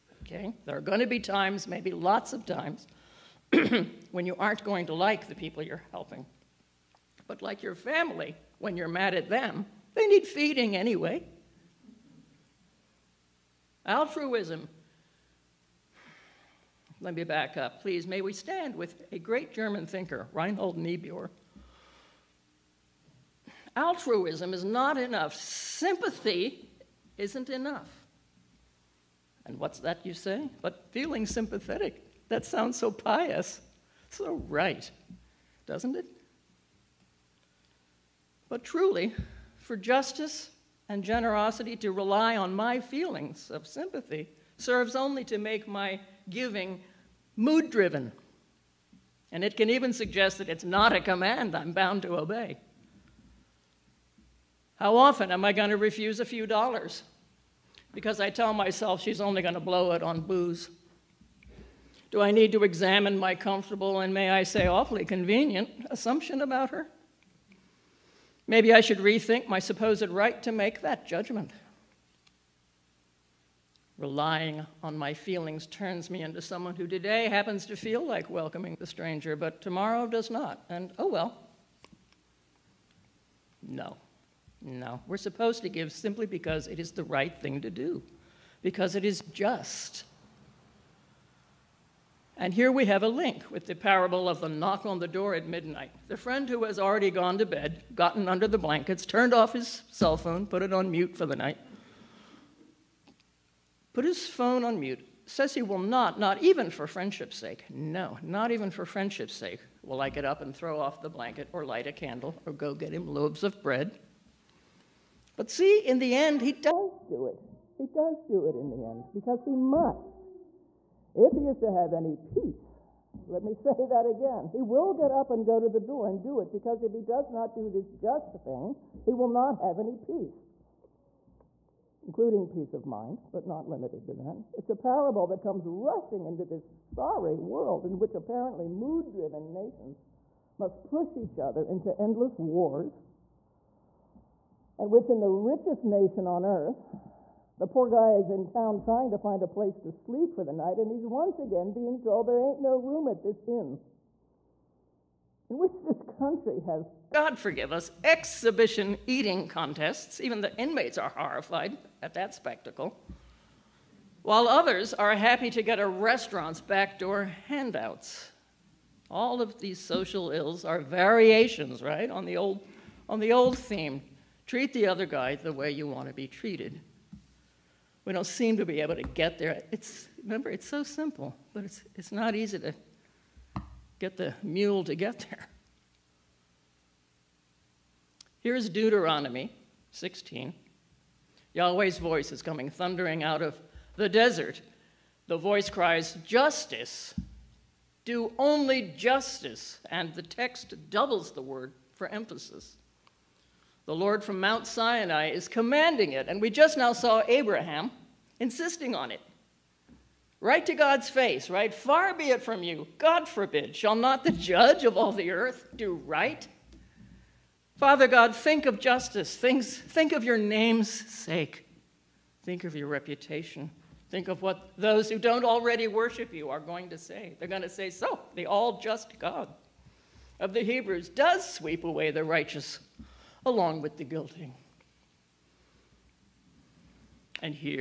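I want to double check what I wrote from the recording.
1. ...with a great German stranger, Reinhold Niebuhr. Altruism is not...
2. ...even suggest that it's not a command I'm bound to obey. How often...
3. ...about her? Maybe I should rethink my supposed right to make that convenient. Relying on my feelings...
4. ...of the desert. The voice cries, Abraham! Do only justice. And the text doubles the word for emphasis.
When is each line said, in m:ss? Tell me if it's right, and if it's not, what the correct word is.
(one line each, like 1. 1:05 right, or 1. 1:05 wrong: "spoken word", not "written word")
1. 0:18 wrong: "thinker", not "stranger"
2. 0:49 right
3. 1:06 wrong: "judgment", not "convenient"
4. 3:13 wrong: "Justice", not "Abraham".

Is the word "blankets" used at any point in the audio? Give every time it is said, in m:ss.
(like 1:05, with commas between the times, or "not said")
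1:38, 1:51.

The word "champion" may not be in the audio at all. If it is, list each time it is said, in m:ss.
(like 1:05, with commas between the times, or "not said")
not said.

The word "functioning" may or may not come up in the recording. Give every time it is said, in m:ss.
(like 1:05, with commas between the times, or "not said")
not said.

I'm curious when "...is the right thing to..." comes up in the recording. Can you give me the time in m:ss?
1:26.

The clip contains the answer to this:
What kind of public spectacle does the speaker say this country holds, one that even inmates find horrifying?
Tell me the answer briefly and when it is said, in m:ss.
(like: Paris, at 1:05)
Exhibition eating contests, at 2:38.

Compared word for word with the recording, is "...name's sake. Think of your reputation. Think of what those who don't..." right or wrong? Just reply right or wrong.
right.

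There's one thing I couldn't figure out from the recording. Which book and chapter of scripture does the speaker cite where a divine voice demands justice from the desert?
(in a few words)
Deuteronomy 16.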